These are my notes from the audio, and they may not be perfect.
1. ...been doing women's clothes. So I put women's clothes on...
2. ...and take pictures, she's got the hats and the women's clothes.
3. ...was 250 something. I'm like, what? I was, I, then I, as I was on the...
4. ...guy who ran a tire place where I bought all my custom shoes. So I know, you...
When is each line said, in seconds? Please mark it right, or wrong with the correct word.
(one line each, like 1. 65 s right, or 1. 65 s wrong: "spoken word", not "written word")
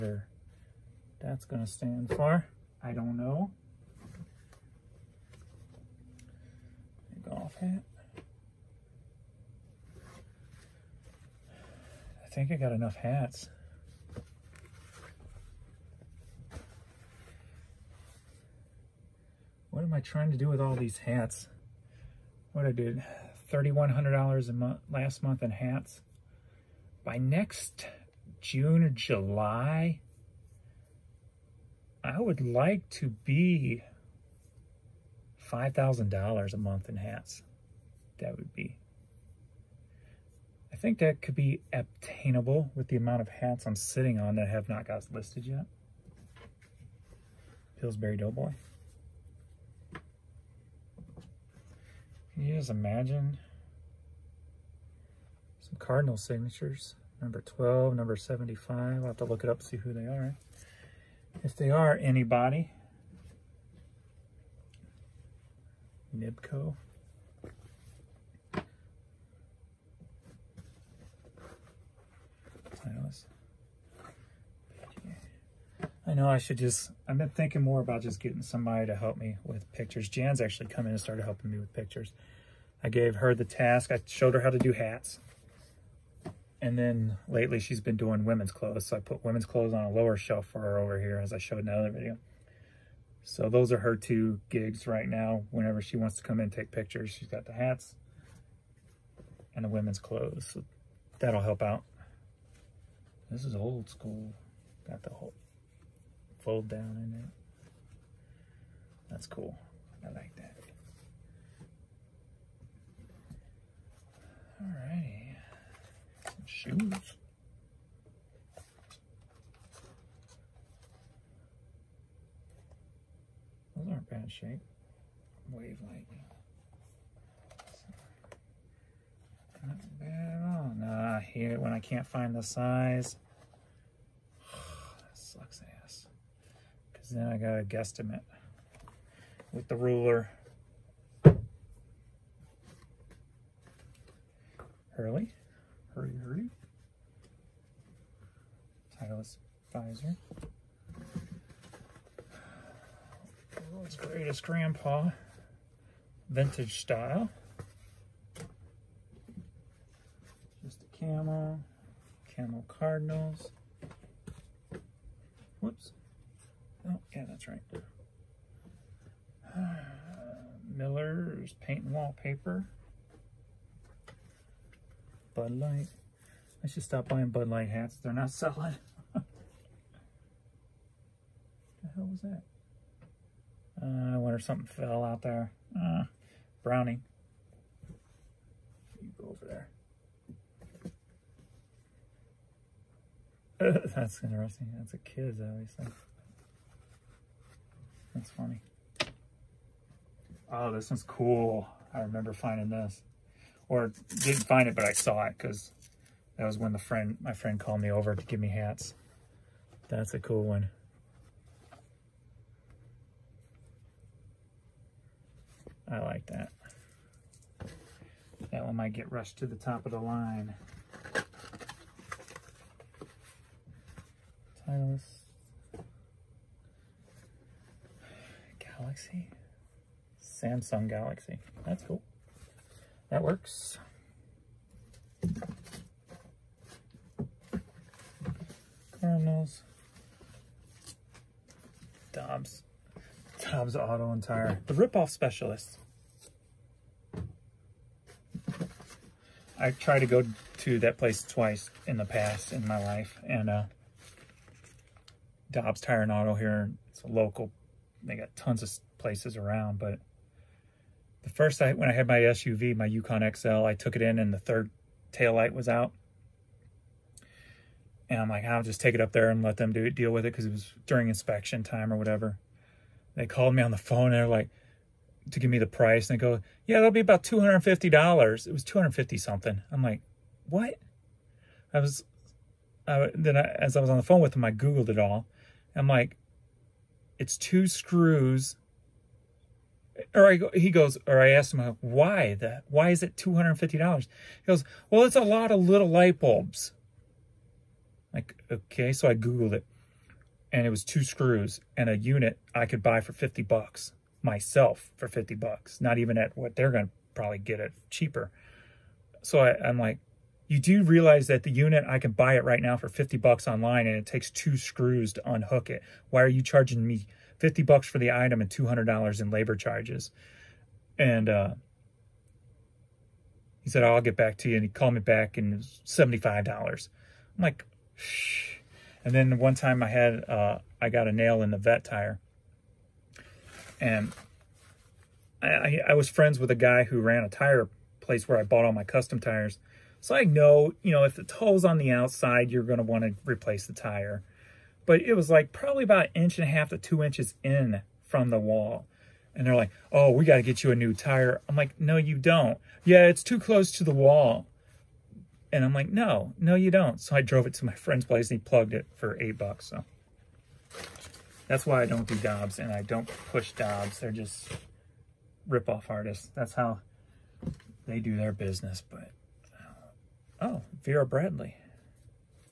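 1. 87 s right
2. 96 s right
3. 278 s right
4. 336 s wrong: "tires", not "shoes".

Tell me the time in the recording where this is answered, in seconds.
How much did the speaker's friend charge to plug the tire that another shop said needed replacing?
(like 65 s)
359 s.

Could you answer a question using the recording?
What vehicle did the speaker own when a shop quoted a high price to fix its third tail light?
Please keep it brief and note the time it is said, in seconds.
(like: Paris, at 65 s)
Yukon XL, at 262 s.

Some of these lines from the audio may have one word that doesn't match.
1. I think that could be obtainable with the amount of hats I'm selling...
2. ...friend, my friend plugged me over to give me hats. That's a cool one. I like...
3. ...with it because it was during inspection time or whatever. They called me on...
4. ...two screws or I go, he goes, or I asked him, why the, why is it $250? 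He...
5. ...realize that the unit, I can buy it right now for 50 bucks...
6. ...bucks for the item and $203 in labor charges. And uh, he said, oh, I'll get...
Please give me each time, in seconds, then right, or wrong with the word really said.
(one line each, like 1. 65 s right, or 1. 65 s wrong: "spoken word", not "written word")
1. 40 s wrong: "sitting", not "selling"
2. 206 s wrong: "called", not "plugged"
3. 270 s right
4. 287 s right
5. 310 s right
6. 317 s wrong: "200", not "203".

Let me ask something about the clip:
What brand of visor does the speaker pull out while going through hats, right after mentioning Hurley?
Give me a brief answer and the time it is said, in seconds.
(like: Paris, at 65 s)
Titleist, at 148 s.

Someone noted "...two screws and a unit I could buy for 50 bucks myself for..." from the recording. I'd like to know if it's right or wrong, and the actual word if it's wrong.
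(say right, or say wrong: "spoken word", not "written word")
right.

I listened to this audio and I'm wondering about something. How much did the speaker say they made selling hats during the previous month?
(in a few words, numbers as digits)
$3,100.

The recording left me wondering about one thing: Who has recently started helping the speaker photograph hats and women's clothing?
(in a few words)
Jan.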